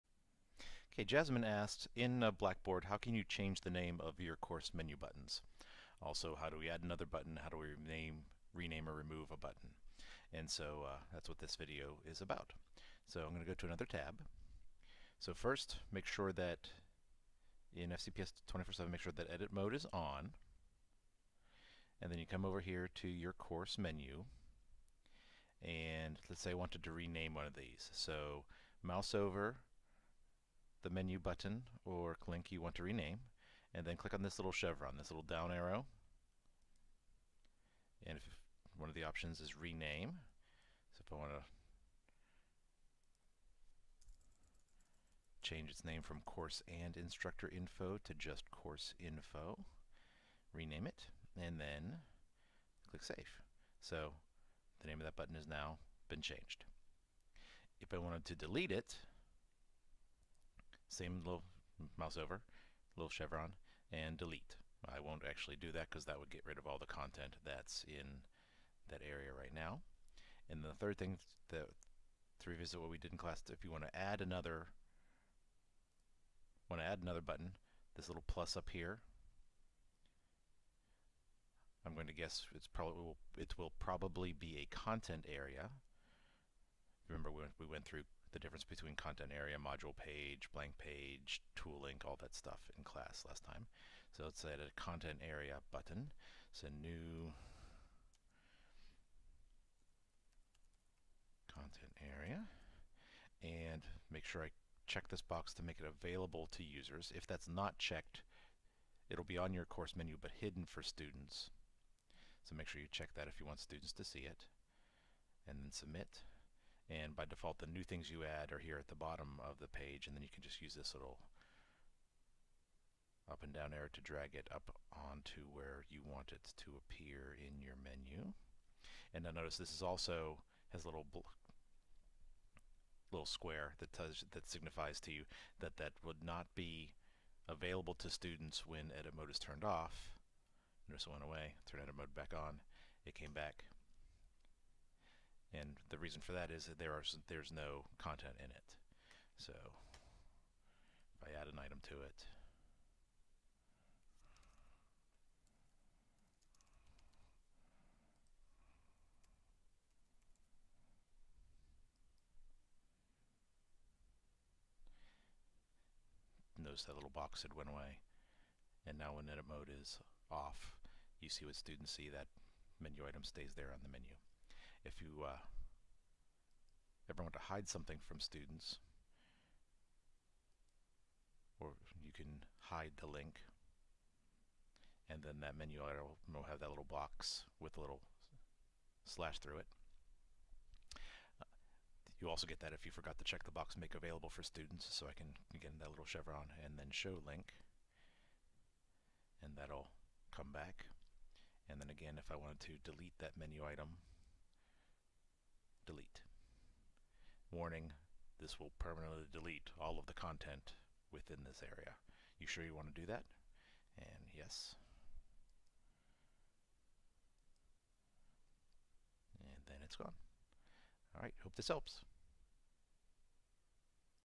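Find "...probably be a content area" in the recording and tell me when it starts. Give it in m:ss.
1:23.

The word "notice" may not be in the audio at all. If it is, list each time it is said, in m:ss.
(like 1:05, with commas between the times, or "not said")
2:09, 2:20, 2:46.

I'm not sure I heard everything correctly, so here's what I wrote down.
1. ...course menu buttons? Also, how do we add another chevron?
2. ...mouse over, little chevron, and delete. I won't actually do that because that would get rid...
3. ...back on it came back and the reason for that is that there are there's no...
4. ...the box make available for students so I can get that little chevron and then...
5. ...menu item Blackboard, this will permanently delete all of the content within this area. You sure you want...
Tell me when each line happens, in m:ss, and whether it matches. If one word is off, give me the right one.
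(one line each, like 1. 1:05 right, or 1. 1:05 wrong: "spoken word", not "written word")
1. 0:04 wrong: "button", not "chevron"
2. 1:01 right
3. 2:22 right
4. 3:13 right
5. 3:23 wrong: "Warning", not "Blackboard".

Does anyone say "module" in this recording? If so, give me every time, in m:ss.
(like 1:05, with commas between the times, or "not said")
1:29.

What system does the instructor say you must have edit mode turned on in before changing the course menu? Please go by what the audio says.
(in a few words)
FCPS 24-7.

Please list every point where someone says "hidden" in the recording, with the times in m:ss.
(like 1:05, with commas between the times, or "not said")
1:50.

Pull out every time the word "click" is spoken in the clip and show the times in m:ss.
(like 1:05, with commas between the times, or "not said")
0:33, 0:52.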